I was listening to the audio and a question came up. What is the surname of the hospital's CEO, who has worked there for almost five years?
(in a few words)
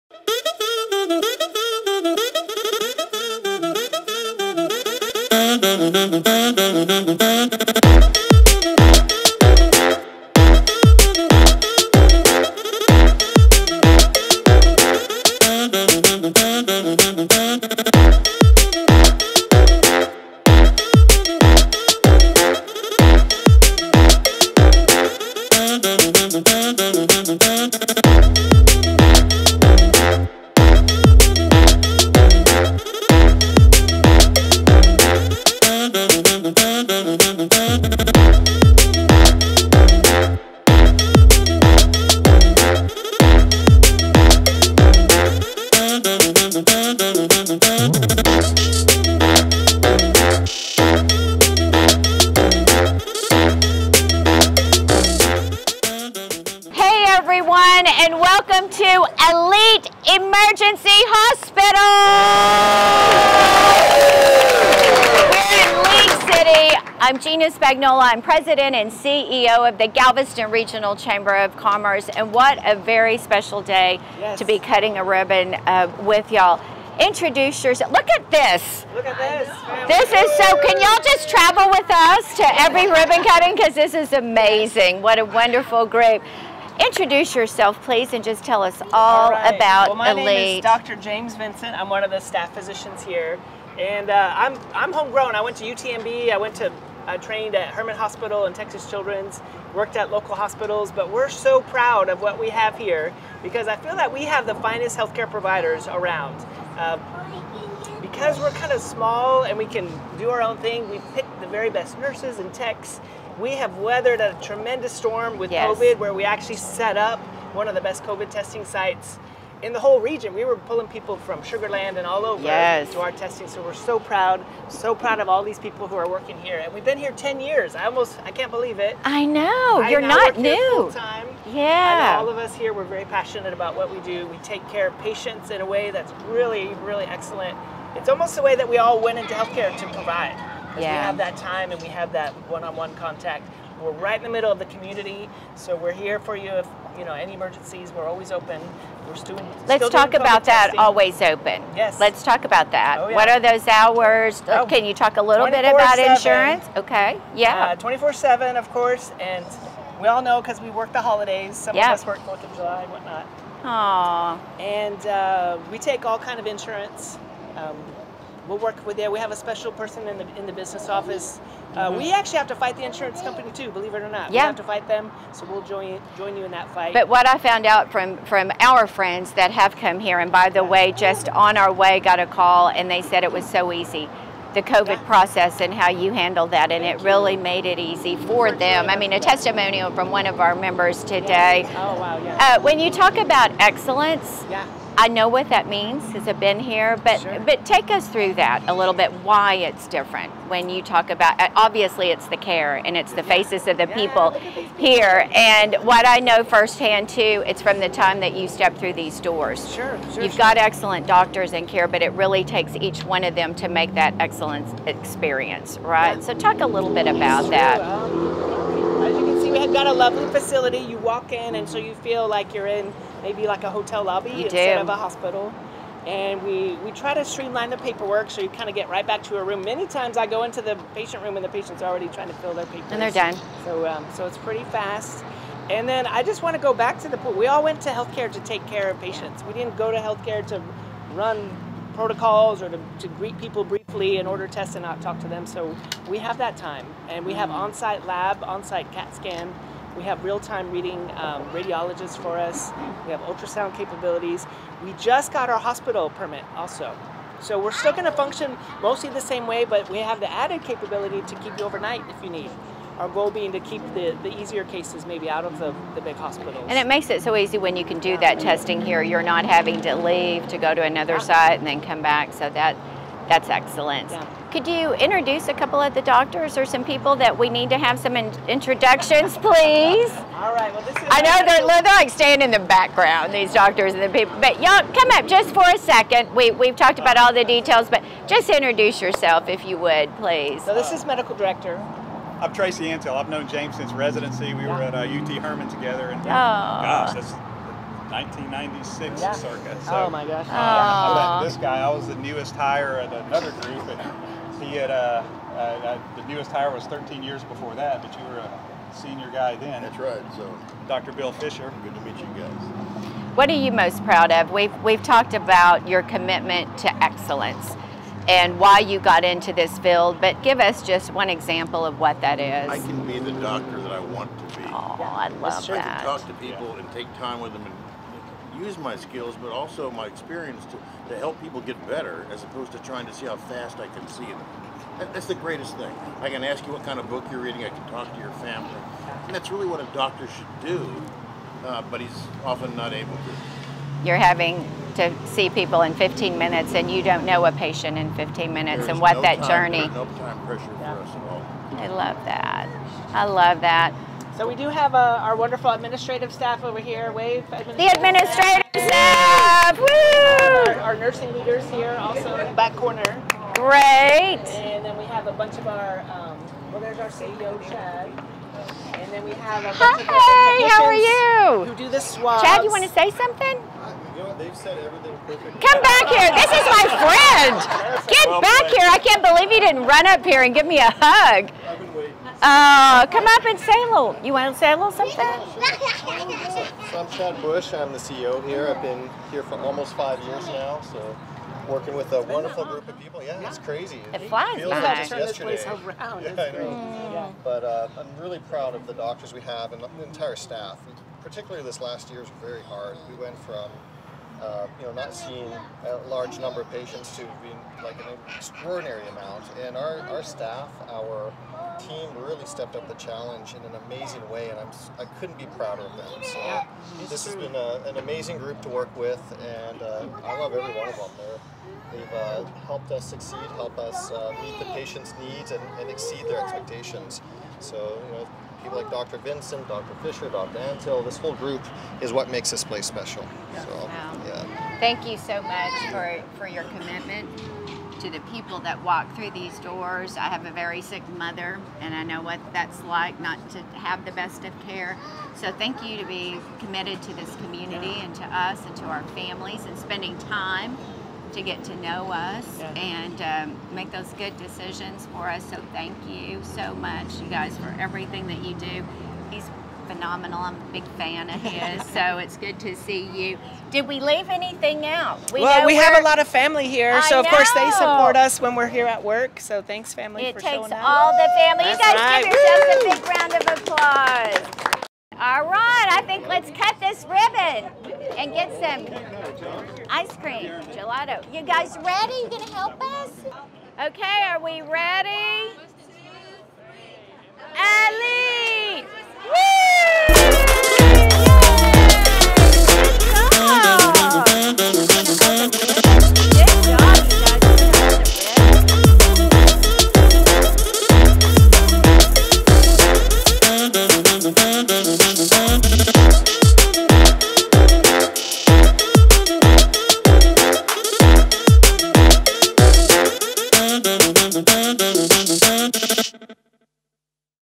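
Bush.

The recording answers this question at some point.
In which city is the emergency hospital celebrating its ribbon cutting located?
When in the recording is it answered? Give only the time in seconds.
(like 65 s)
65 s.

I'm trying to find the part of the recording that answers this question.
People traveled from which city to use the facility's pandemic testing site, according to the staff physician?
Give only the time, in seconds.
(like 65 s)
121 s.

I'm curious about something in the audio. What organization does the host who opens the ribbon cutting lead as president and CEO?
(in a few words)
Galveston Regional Chamber of Commerce.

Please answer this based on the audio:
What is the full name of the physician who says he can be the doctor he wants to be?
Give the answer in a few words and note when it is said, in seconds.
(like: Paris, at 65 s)
Bill Fisher, at 310 s.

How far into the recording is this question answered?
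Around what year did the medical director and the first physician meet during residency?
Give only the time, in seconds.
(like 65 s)
298 s.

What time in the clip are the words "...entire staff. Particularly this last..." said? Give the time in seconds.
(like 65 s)
400 s.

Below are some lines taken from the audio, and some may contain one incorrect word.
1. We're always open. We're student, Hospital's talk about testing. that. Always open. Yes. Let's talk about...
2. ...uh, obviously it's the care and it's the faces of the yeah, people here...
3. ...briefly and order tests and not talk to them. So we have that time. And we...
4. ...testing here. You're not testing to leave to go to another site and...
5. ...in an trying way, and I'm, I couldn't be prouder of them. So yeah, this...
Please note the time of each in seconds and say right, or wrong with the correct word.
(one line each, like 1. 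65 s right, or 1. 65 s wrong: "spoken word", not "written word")
1. 147 s wrong: "Let", not "Hospital"
2. 201 s right
3. 243 s right
4. 268 s wrong: "having", not "testing"
5. 413 s wrong: "amazing", not "trying".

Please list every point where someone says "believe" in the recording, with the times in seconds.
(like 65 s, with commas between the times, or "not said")
128 s, 173 s, 379 s.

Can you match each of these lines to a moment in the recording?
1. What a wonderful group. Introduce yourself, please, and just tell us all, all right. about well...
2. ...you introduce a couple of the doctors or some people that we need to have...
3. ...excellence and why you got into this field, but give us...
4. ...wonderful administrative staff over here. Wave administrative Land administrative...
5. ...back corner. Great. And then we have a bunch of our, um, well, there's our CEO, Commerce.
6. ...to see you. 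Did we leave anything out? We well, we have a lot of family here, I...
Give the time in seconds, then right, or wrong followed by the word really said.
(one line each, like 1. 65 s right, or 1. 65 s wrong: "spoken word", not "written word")
1. 85 s right
2. 274 s right
3. 317 s right
4. 355 s wrong: "The", not "Land"
5. 362 s wrong: "Chad", not "Commerce"
6. 462 s right.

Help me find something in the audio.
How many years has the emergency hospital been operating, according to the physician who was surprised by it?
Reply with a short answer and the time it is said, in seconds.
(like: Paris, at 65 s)
10, at 127 s.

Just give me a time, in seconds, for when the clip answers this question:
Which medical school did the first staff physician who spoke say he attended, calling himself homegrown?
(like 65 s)
95 s.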